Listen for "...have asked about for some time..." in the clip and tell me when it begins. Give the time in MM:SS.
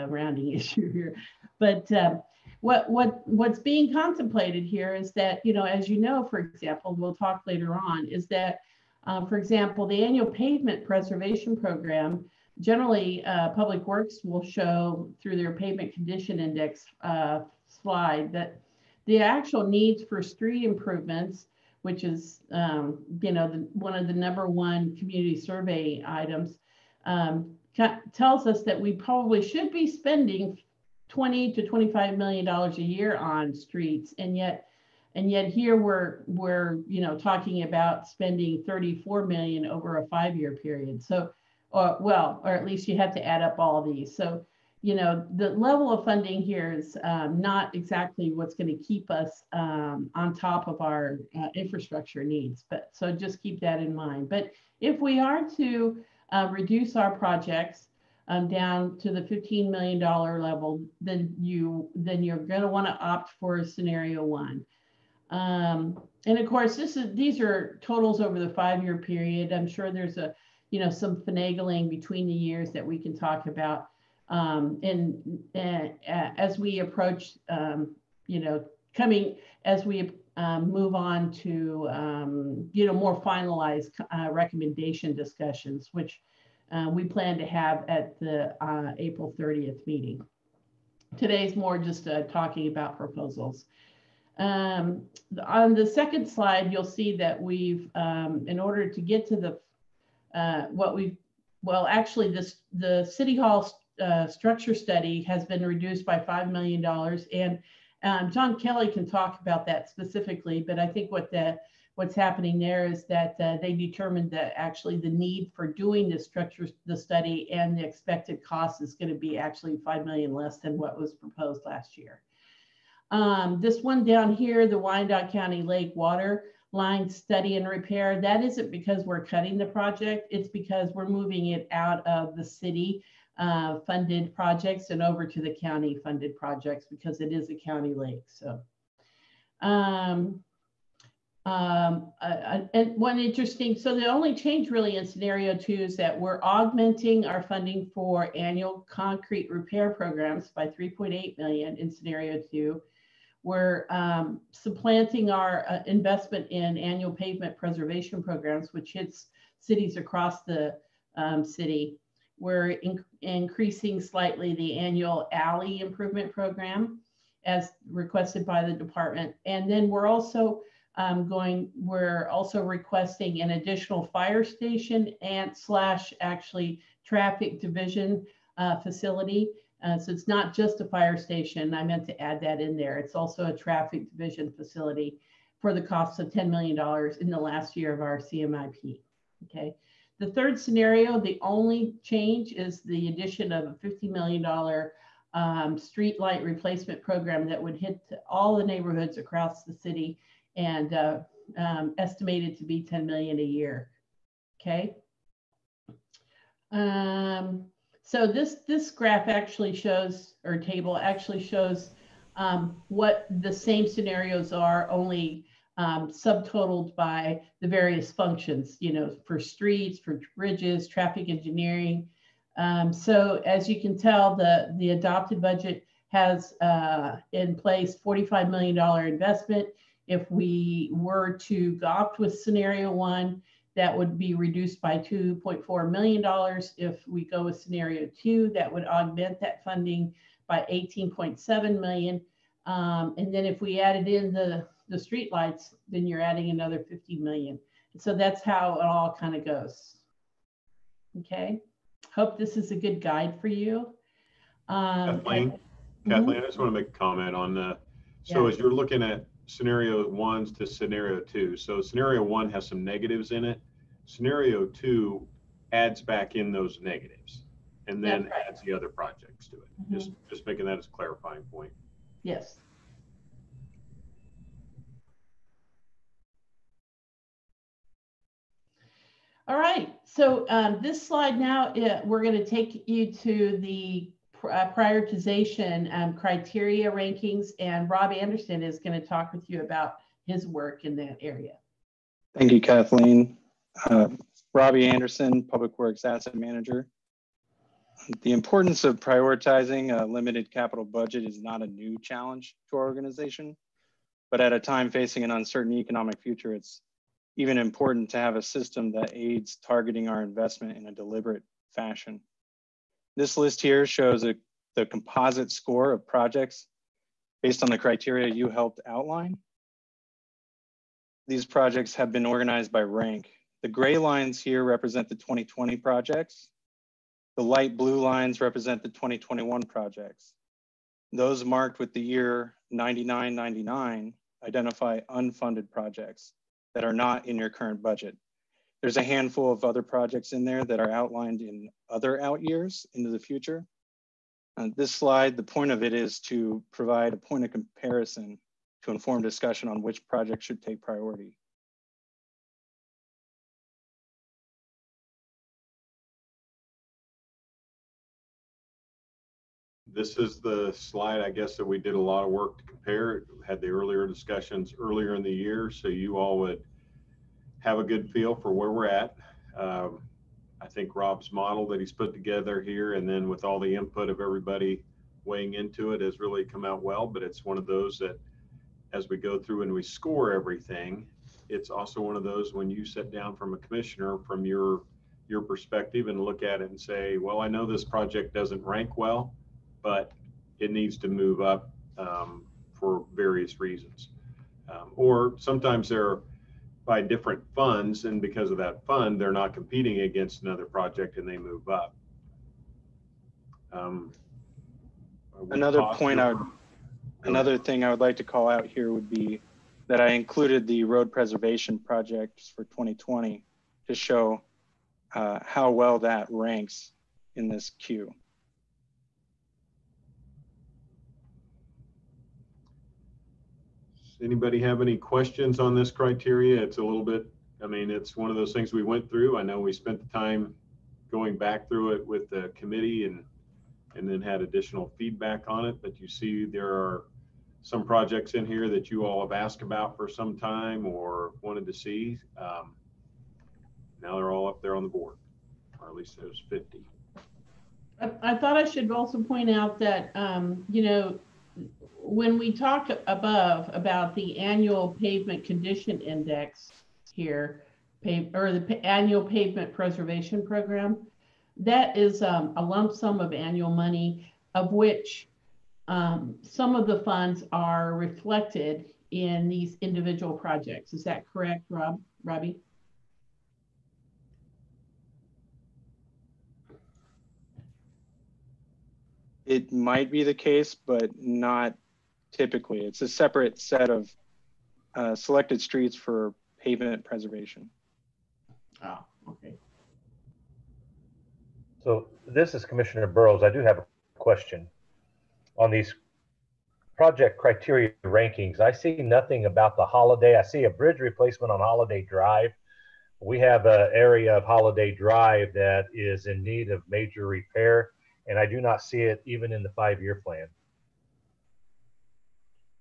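07:19.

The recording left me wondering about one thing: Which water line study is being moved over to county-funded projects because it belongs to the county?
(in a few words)
Wyandotte County Lake.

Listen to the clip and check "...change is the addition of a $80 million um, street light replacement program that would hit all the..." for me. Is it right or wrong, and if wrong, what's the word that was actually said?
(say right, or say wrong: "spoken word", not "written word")
wrong: "50", not "80".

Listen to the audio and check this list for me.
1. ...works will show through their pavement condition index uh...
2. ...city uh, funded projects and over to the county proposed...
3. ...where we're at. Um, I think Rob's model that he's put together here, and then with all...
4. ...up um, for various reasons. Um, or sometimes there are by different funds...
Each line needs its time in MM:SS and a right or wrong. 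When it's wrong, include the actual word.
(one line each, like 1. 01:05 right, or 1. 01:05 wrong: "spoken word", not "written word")
1. 00:13 right
2. 02:12 wrong: "funded", not "proposed"
3. 06:08 right
4. 06:31 right.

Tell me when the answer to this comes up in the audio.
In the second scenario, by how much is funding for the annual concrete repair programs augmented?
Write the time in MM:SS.
02:30.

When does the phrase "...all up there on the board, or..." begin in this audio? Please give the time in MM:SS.
07:24.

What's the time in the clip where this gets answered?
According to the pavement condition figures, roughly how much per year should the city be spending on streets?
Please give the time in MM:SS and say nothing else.
00:31.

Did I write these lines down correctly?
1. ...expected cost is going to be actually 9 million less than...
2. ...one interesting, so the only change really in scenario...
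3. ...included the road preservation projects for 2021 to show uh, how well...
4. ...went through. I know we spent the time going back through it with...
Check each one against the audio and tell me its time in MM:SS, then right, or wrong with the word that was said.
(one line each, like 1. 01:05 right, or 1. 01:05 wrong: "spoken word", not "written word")
1. 01:57 wrong: "5", not "9"
2. 02:22 right
3. 06:50 wrong: "2020", not "2021"
4. 07:08 right.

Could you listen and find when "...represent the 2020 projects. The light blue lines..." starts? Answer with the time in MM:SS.
05:24.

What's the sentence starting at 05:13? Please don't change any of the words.
This list here shows a, the composite score of projects based on the criteria you helped outline.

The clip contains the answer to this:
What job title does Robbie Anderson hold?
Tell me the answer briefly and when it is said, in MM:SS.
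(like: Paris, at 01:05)
Public Works Asset Manager, at 04:55.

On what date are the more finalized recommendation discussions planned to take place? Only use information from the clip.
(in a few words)
April 30th.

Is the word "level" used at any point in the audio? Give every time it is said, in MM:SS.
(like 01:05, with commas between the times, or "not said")
00:45, 00:59.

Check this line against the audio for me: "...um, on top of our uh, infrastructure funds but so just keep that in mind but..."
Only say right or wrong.
wrong.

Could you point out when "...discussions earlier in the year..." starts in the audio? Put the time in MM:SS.
06:04.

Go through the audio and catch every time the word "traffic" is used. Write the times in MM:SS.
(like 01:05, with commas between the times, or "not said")
02:57, 03:03, 03:40.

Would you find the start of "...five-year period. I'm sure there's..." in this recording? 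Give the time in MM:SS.
01:08.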